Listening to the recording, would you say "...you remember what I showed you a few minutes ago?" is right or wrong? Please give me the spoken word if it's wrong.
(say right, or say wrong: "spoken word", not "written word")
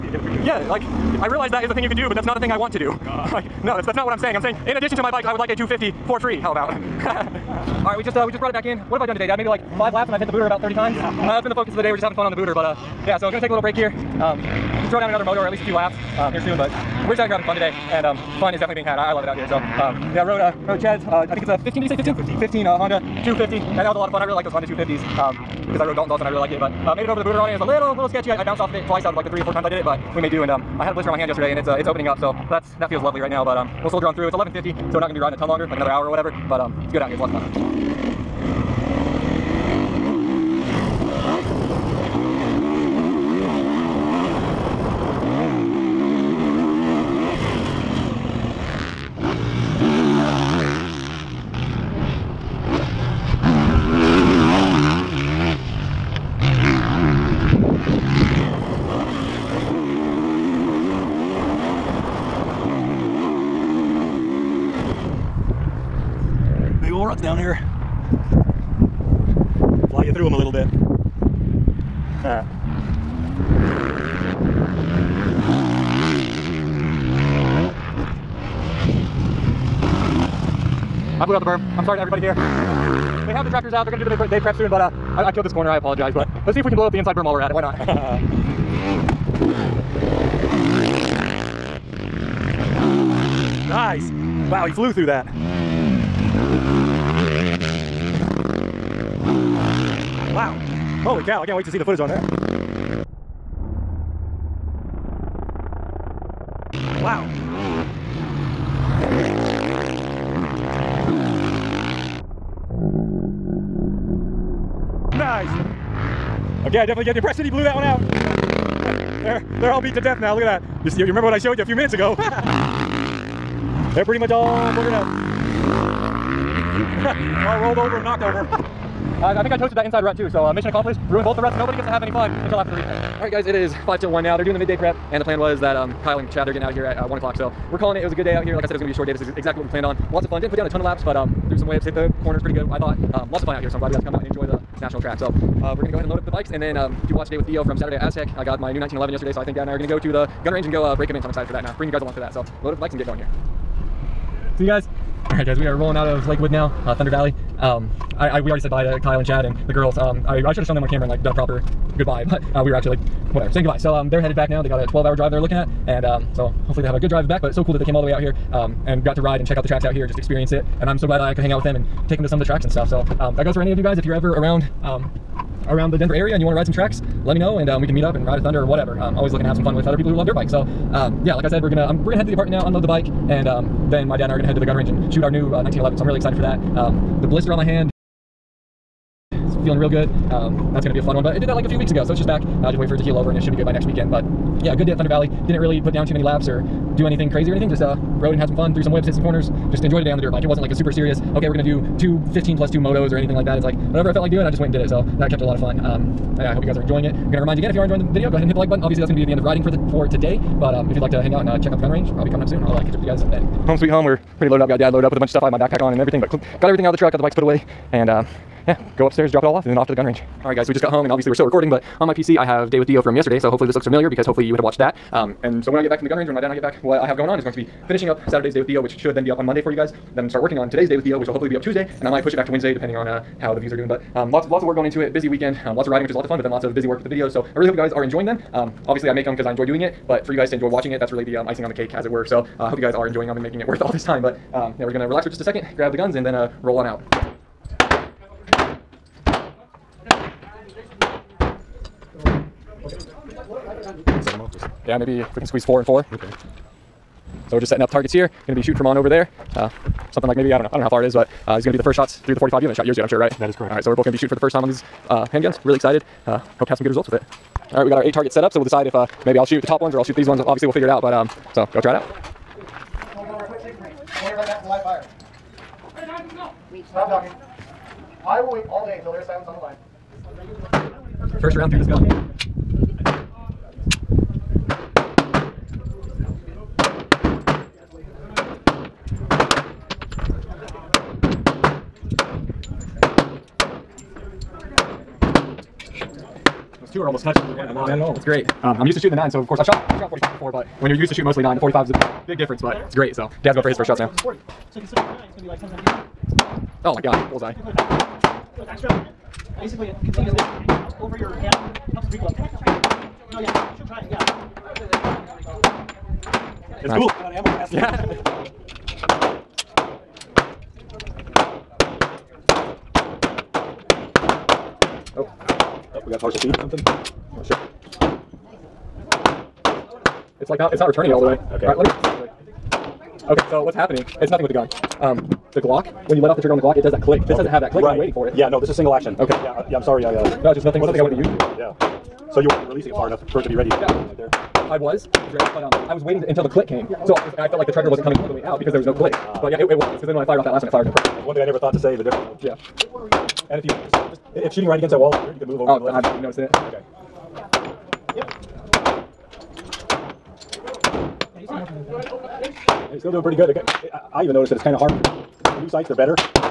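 right.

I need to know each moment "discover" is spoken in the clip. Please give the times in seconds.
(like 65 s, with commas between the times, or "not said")
not said.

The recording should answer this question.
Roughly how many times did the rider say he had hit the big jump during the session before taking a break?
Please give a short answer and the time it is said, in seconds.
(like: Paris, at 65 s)
30, at 10 s.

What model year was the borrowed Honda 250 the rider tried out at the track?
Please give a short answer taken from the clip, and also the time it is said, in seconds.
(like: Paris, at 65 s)
2015, at 22 s.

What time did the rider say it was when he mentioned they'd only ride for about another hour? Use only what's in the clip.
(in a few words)
11:50.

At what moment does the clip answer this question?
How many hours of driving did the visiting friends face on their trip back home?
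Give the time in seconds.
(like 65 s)
164 s.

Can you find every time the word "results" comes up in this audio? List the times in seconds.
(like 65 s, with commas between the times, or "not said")
266 s.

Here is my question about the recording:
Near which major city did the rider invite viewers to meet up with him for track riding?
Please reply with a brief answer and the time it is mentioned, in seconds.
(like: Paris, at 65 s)
Denver, at 175 s.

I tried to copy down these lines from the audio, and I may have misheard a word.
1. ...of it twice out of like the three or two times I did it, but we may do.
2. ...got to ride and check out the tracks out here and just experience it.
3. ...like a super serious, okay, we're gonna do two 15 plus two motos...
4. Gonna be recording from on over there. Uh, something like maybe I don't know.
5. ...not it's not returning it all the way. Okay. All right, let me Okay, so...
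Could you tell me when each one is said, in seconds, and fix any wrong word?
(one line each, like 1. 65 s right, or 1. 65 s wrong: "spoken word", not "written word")
1. 28 s wrong: "four", not "two"
2. 169 s right
3. 200 s right
4. 258 s wrong: "shooting", not "recording"
5. 330 s right.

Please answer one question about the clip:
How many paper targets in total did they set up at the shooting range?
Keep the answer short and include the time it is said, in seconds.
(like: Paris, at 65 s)
8, at 268 s.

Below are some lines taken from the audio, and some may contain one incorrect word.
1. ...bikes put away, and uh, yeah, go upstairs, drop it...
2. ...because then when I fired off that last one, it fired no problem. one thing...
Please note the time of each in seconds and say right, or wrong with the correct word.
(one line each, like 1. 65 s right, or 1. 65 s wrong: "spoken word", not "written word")
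1. 217 s right
2. 349 s right.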